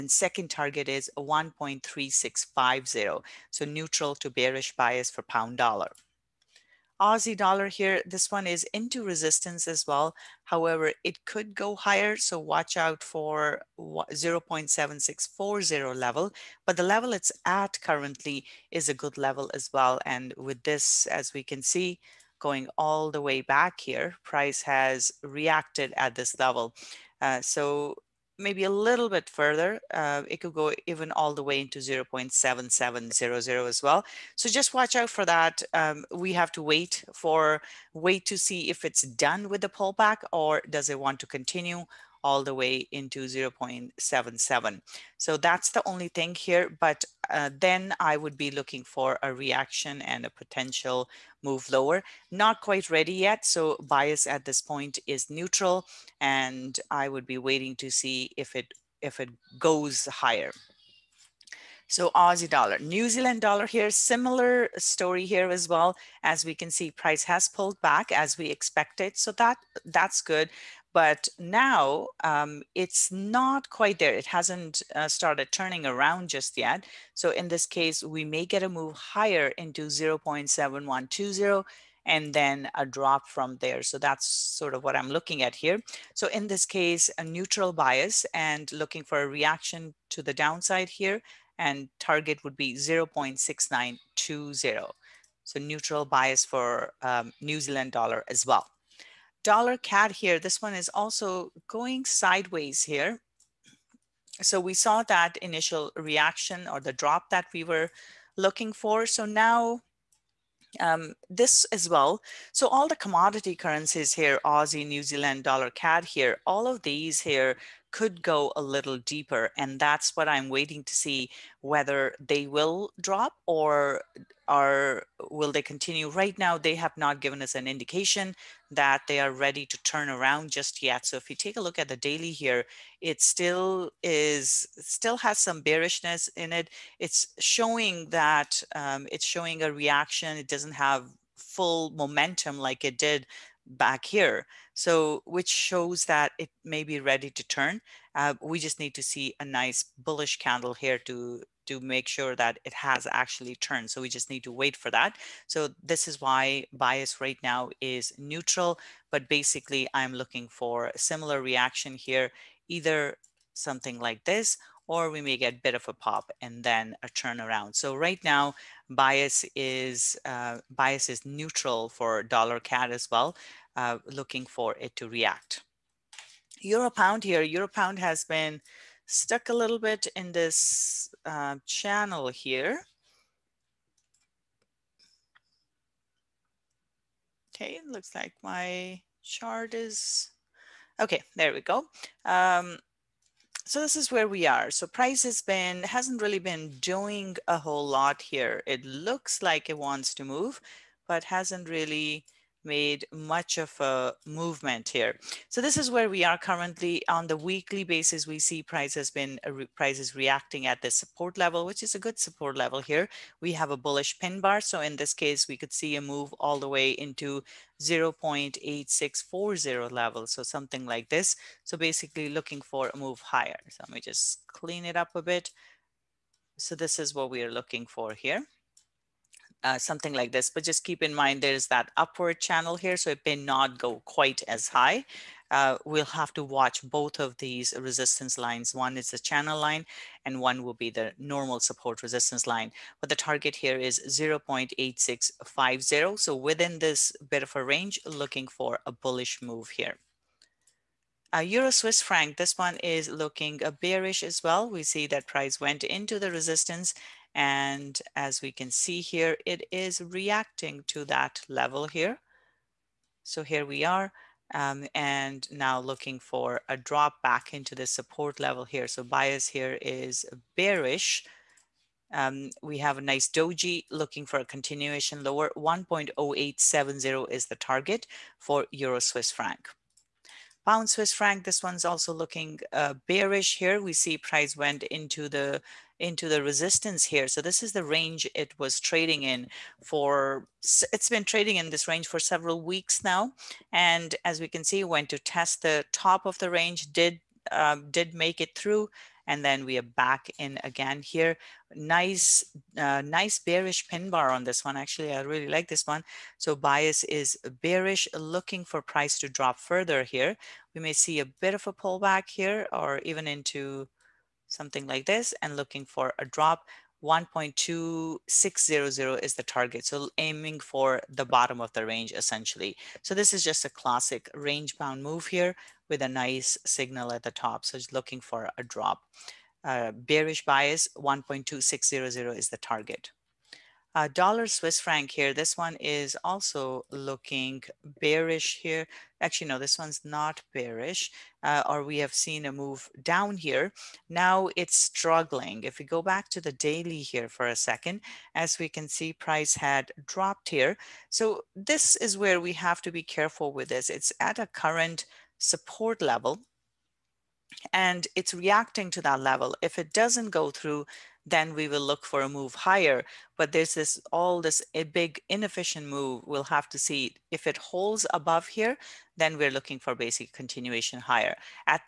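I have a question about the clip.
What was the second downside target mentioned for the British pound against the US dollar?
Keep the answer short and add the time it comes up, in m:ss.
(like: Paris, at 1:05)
1.3650, at 0:01.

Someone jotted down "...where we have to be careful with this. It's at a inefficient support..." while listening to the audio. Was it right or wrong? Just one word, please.
wrong.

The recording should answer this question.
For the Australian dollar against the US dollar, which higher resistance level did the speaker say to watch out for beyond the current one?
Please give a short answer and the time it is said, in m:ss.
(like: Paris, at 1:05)
0.7640, at 0:13.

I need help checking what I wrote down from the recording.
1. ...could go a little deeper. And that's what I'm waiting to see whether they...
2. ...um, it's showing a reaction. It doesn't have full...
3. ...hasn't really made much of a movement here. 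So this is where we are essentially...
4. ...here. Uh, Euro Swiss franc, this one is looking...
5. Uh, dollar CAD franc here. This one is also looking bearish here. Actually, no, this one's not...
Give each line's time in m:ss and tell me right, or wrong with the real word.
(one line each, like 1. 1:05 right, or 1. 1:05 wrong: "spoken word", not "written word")
1. 1:57 right
2. 2:18 right
3. 3:21 wrong: "currently", not "essentially"
4. 4:09 right
5. 5:33 wrong: "Swiss", not "CAD".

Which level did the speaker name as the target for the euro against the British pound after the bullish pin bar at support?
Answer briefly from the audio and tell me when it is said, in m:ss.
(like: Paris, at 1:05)
0.8650, at 4:04.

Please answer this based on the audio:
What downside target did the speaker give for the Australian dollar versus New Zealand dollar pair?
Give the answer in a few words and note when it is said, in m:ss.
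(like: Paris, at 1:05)
0.6920, at 1:32.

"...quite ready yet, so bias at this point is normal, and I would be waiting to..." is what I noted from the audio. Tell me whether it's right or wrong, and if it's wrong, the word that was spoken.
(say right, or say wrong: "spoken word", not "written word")
wrong: "neutral", not "normal".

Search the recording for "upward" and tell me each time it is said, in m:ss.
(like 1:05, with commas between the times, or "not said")
3:51.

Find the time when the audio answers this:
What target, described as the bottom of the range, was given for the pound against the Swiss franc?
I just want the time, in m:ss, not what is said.
5:17.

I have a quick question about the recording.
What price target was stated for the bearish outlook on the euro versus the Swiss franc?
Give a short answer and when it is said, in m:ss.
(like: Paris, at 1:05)
1.0870, at 4:35.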